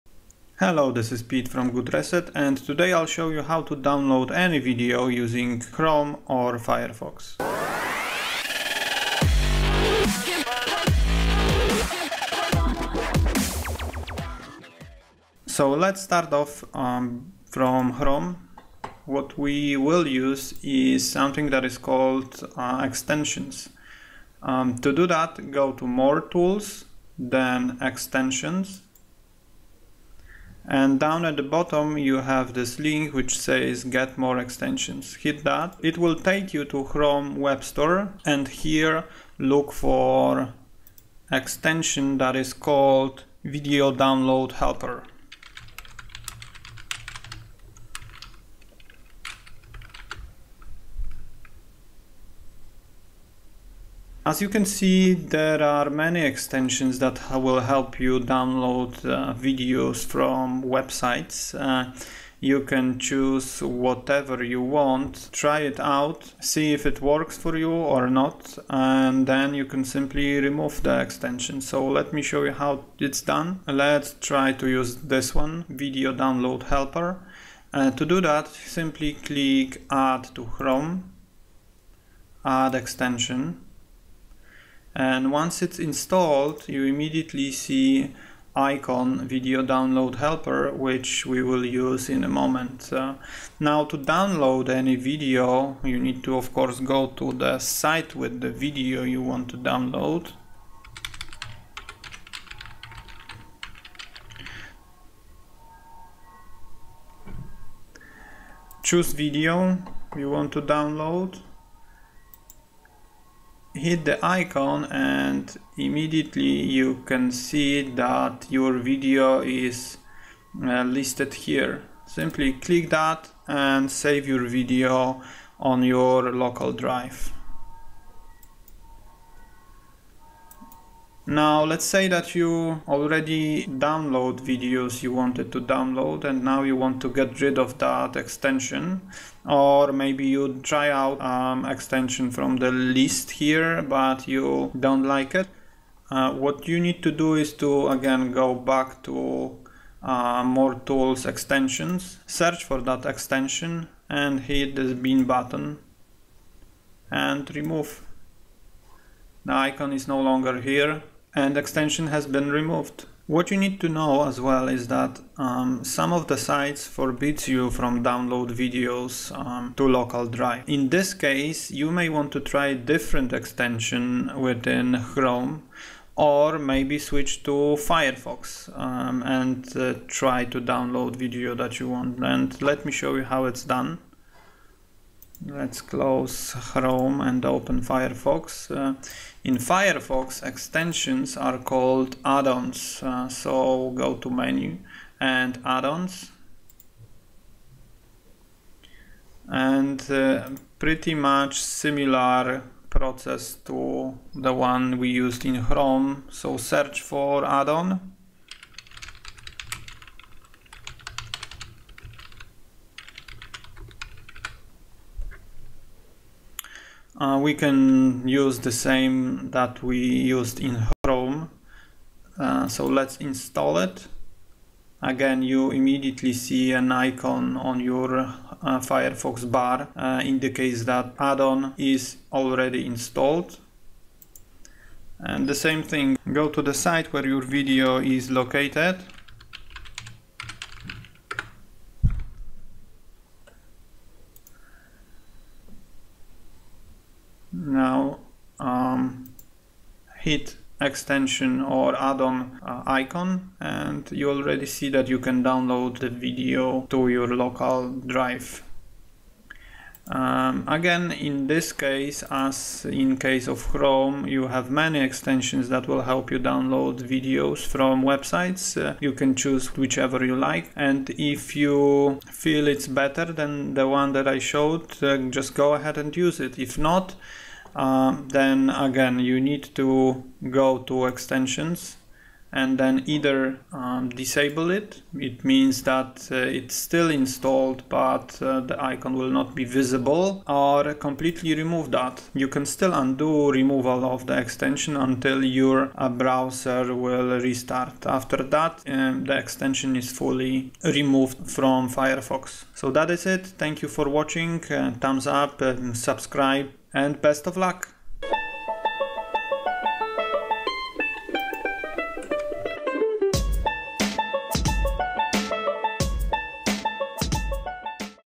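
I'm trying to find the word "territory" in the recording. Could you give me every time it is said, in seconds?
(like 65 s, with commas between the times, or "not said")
not said.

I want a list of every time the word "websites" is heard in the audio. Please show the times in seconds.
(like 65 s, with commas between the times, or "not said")
60 s, 268 s.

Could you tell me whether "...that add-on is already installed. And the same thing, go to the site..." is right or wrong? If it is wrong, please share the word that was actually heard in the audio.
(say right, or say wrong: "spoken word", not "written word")
right.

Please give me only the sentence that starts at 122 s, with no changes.
Simply click that and save your video on your local drive.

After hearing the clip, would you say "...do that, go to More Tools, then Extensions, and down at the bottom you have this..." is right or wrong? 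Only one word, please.
right.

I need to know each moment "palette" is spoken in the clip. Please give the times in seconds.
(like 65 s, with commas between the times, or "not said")
not said.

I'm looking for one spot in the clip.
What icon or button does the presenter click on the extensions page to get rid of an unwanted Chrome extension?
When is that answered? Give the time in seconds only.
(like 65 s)
154 s.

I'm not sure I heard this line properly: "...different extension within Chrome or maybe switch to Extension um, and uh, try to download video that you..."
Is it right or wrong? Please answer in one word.
wrong.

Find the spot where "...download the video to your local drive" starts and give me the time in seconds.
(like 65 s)
255 s.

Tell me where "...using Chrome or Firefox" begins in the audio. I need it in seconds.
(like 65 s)
5 s.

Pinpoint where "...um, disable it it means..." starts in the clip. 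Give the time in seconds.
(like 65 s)
283 s.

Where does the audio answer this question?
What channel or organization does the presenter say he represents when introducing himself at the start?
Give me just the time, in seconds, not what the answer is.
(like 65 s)
1 s.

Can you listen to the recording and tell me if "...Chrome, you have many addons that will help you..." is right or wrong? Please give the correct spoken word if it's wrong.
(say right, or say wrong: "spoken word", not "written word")
wrong: "extensions", not "addons".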